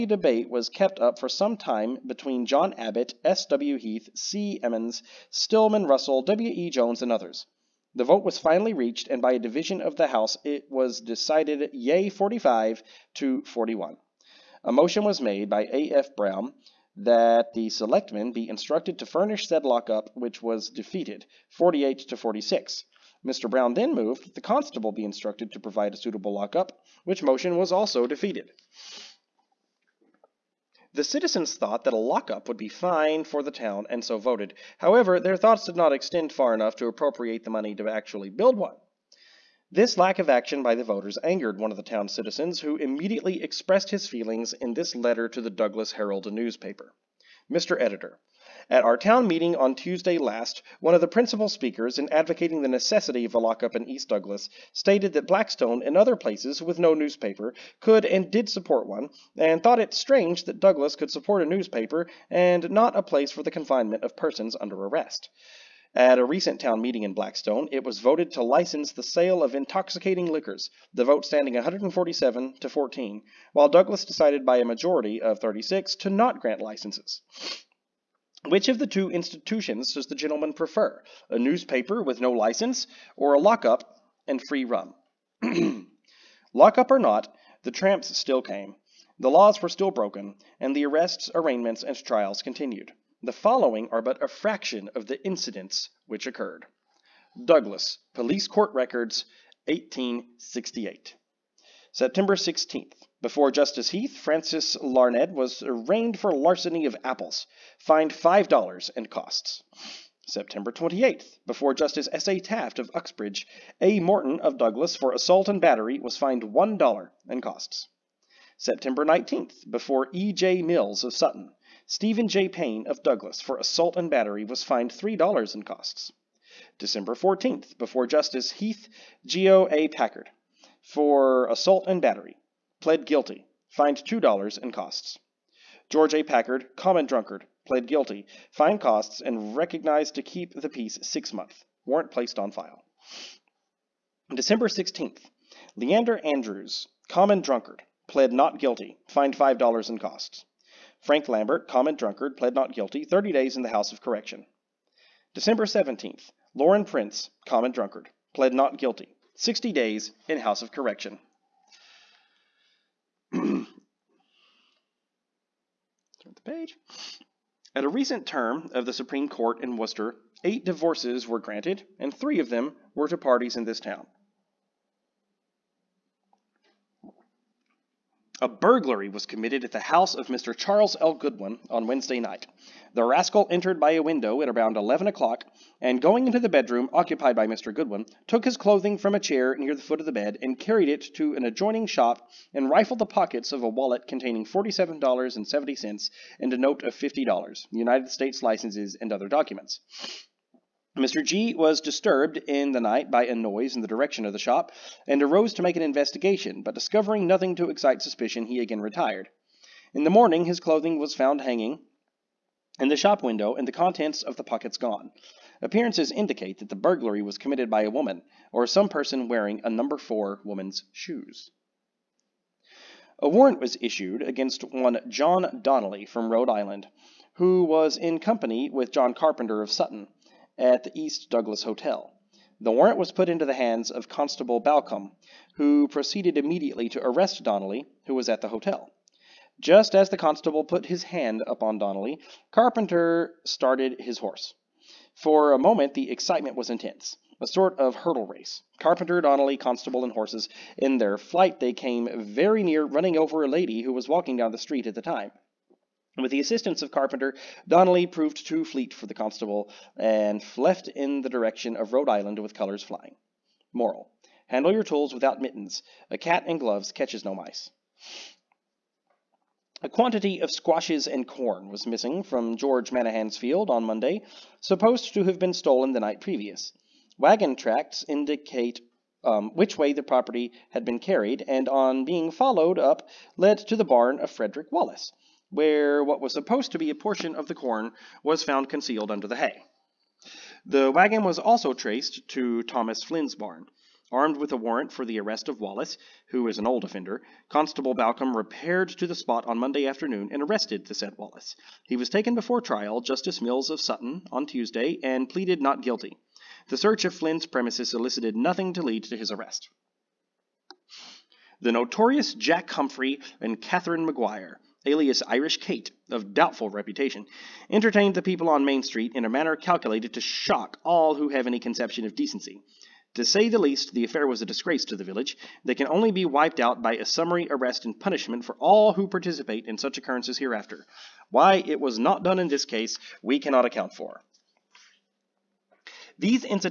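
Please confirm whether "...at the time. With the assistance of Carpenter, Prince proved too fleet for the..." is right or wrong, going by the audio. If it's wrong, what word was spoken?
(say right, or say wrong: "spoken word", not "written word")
wrong: "Donnelly", not "Prince".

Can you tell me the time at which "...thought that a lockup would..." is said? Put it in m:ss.
0:31.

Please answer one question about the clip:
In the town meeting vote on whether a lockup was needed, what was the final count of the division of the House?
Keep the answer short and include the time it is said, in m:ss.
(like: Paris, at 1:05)
45 to 41, at 0:12.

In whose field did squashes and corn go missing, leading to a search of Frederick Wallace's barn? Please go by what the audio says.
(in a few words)
George Manahan.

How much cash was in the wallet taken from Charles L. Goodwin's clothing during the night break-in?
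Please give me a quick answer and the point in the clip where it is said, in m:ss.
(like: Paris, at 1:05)
$47.70, at 3:14.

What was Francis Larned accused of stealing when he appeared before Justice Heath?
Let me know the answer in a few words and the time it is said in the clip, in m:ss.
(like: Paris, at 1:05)
apples, at 1:47.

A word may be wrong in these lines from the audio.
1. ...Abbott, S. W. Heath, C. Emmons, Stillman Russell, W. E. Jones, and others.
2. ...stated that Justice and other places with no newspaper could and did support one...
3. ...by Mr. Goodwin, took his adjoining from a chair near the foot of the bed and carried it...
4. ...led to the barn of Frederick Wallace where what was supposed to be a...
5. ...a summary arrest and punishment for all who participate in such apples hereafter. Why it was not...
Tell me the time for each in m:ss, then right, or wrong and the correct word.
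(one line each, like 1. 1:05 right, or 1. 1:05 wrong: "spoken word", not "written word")
1. 0:02 right
2. 0:54 wrong: "Blackstone", not "Justice"
3. 3:07 wrong: "clothing", not "adjoining"
4. 4:43 right
5. 5:26 wrong: "occurrences", not "apples".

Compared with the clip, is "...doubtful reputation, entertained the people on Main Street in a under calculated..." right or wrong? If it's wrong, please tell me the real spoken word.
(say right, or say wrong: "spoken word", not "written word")
wrong: "manner", not "under".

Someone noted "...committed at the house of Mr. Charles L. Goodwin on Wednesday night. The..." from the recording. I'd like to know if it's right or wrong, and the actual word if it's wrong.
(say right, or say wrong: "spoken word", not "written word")
right.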